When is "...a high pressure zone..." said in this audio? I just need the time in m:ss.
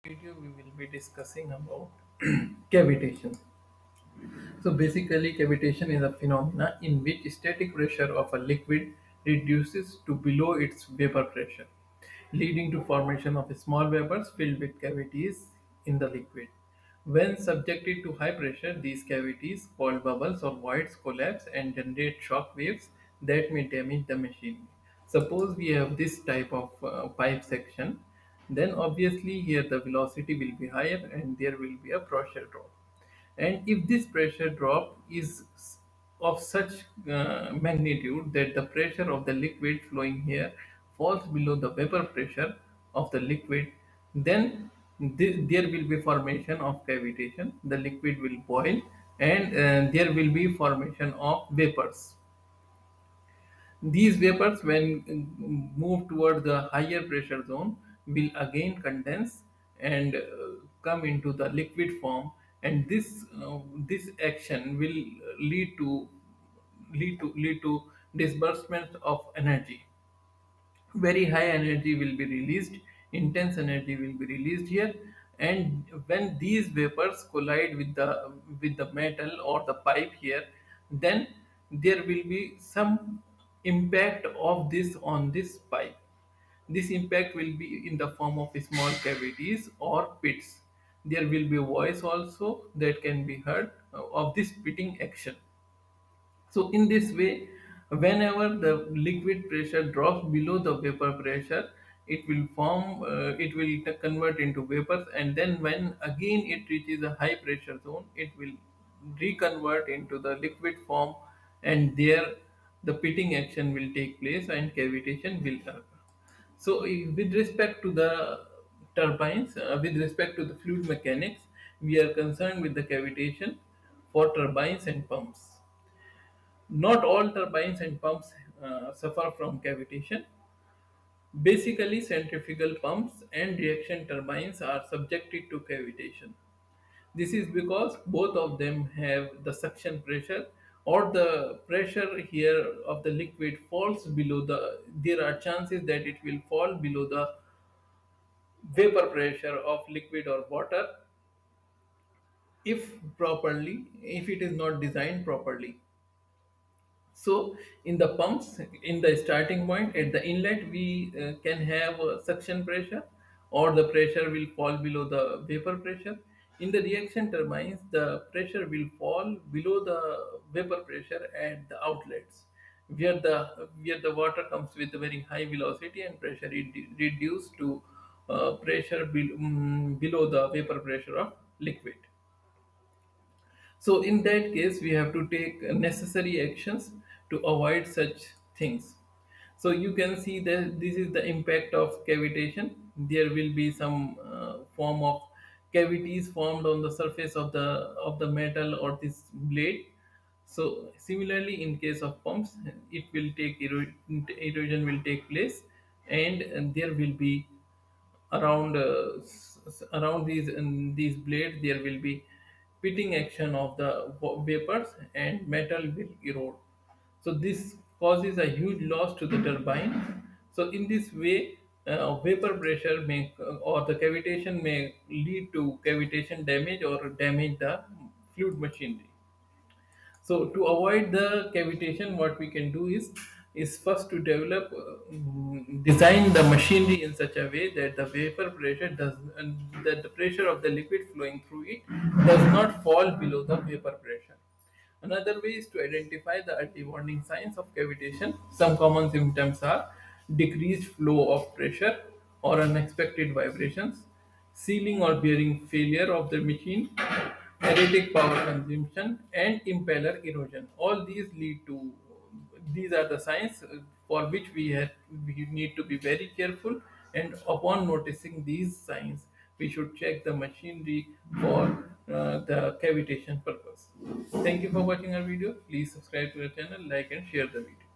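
1:47.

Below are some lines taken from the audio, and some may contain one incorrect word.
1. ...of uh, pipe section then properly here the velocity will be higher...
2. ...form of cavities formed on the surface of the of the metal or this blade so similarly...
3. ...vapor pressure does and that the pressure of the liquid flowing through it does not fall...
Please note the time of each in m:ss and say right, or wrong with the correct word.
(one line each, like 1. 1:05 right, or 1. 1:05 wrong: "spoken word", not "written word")
1. 0:26 wrong: "obviously", not "properly"
2. 3:14 right
3. 3:58 right.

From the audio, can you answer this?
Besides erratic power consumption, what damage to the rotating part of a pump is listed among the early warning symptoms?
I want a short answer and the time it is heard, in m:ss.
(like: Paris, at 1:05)
Impeller erosion, at 4:19.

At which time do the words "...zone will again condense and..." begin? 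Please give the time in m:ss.
0:57.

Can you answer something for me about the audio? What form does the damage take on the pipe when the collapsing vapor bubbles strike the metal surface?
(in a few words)
Small cavities or pits.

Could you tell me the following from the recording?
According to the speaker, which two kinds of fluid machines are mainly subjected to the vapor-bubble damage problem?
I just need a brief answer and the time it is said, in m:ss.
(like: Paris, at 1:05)
Centrifugal pumps and reaction turbines, at 2:11.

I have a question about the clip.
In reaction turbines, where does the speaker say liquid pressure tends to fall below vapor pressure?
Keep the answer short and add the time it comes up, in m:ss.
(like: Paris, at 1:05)
At the outlets, at 2:51.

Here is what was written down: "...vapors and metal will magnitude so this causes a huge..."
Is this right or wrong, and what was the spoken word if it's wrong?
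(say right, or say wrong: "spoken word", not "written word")
wrong: "erode", not "magnitude".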